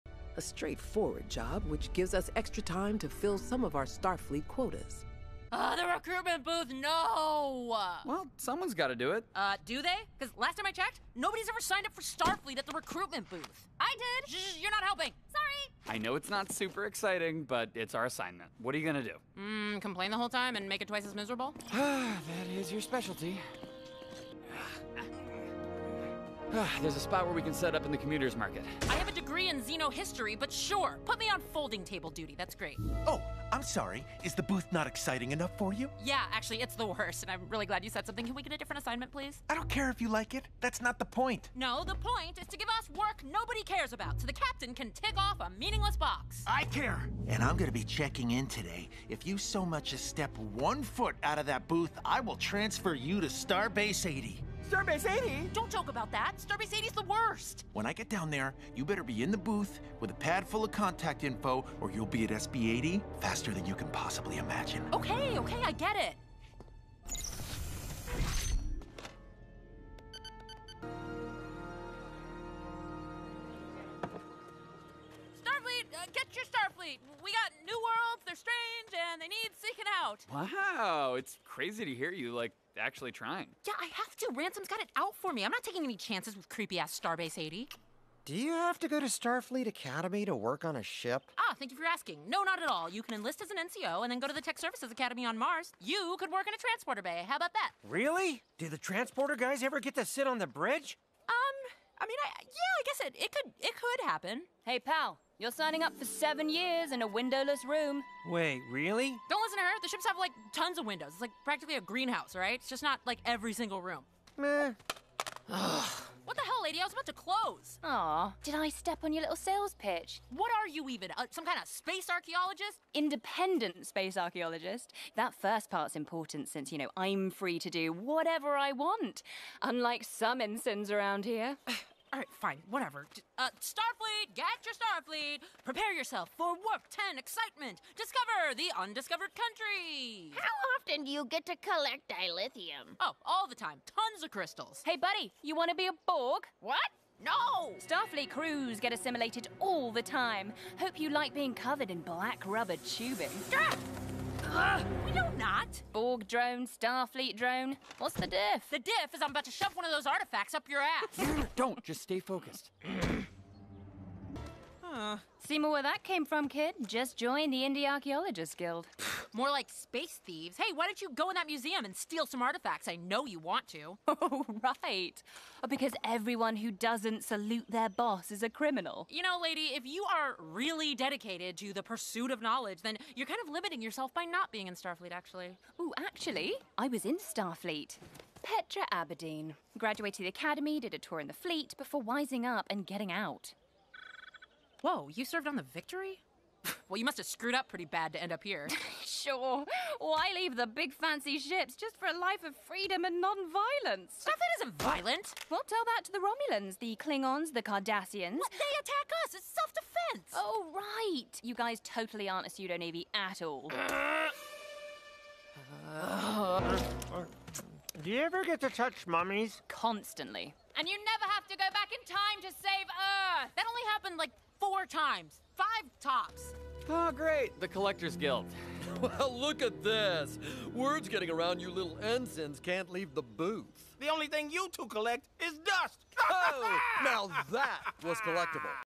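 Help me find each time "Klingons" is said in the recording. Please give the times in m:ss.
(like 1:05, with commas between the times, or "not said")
3:26.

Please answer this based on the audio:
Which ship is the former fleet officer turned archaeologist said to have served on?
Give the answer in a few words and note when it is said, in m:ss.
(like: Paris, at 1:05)
Victory, at 3:15.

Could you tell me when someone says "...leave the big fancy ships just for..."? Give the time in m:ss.
3:20.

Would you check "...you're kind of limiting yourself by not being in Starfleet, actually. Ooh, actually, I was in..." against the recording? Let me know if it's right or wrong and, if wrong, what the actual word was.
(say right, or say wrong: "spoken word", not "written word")
right.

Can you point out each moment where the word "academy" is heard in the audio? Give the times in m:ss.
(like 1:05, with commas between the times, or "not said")
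1:29, 1:34, 3:10.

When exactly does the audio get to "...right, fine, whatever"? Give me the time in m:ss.
2:12.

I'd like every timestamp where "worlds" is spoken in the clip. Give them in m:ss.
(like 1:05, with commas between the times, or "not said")
1:17.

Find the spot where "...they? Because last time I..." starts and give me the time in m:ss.
0:09.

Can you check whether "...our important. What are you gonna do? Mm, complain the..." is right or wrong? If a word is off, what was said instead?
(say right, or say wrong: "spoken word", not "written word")
wrong: "assignment", not "important".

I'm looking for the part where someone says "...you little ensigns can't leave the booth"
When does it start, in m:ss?
3:51.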